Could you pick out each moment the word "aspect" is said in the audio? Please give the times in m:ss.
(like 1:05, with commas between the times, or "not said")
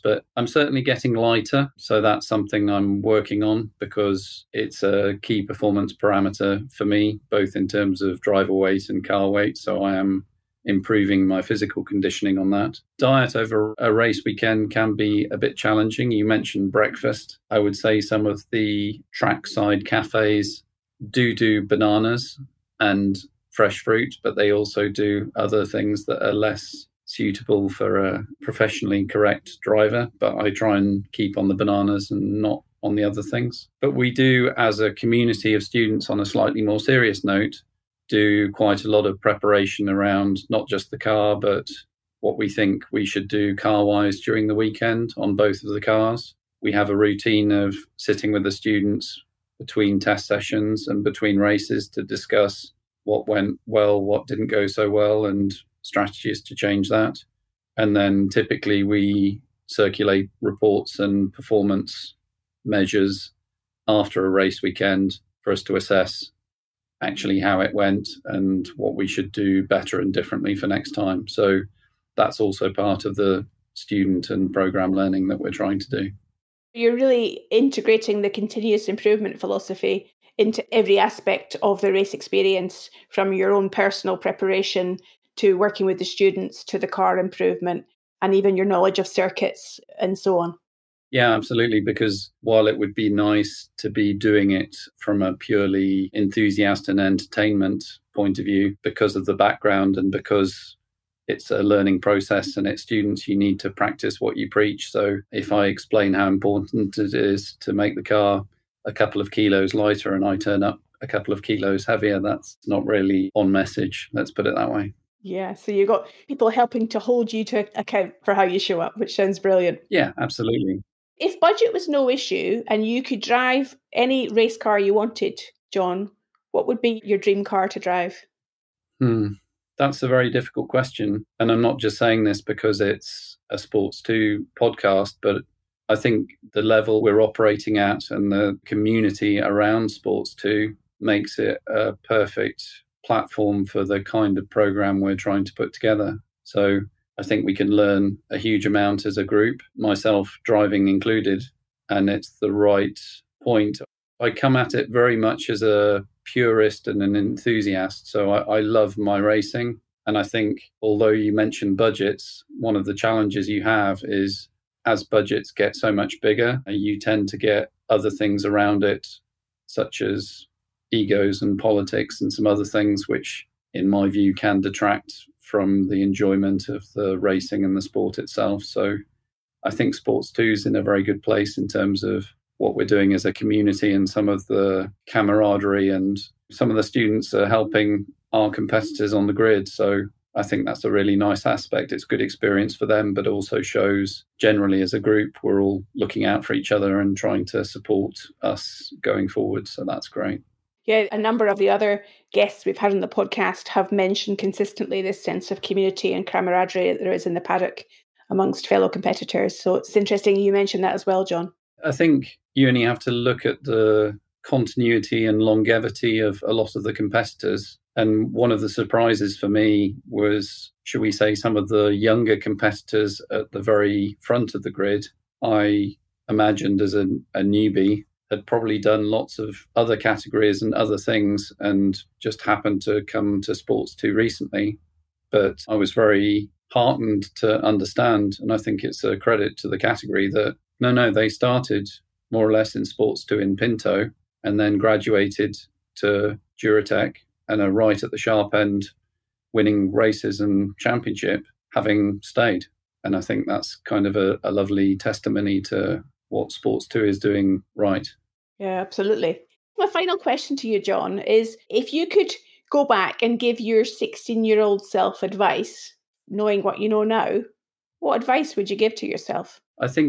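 1:20, 3:11.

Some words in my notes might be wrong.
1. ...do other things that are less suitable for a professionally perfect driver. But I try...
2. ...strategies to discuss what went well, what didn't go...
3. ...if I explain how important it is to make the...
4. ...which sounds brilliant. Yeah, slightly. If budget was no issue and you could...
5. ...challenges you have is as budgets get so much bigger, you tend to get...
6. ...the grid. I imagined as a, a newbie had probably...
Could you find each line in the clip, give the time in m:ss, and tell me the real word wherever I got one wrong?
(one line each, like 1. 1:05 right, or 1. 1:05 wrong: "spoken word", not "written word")
1. 0:24 wrong: "correct", not "perfect"
2. 0:51 wrong: "races", not "strategies"
3. 1:45 right
4. 1:58 wrong: "absolutely", not "slightly"
5. 2:42 right
6. 3:44 right.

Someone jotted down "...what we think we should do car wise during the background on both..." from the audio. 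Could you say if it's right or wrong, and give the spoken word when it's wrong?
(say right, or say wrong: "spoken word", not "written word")
wrong: "weekend", not "background".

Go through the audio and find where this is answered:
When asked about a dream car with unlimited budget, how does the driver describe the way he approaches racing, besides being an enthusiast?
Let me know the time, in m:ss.
2:35.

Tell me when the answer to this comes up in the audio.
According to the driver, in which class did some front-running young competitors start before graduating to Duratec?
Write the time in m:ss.
4:03.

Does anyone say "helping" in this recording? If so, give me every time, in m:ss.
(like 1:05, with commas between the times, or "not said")
1:56, 3:07.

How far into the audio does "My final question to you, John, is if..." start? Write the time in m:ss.
4:19.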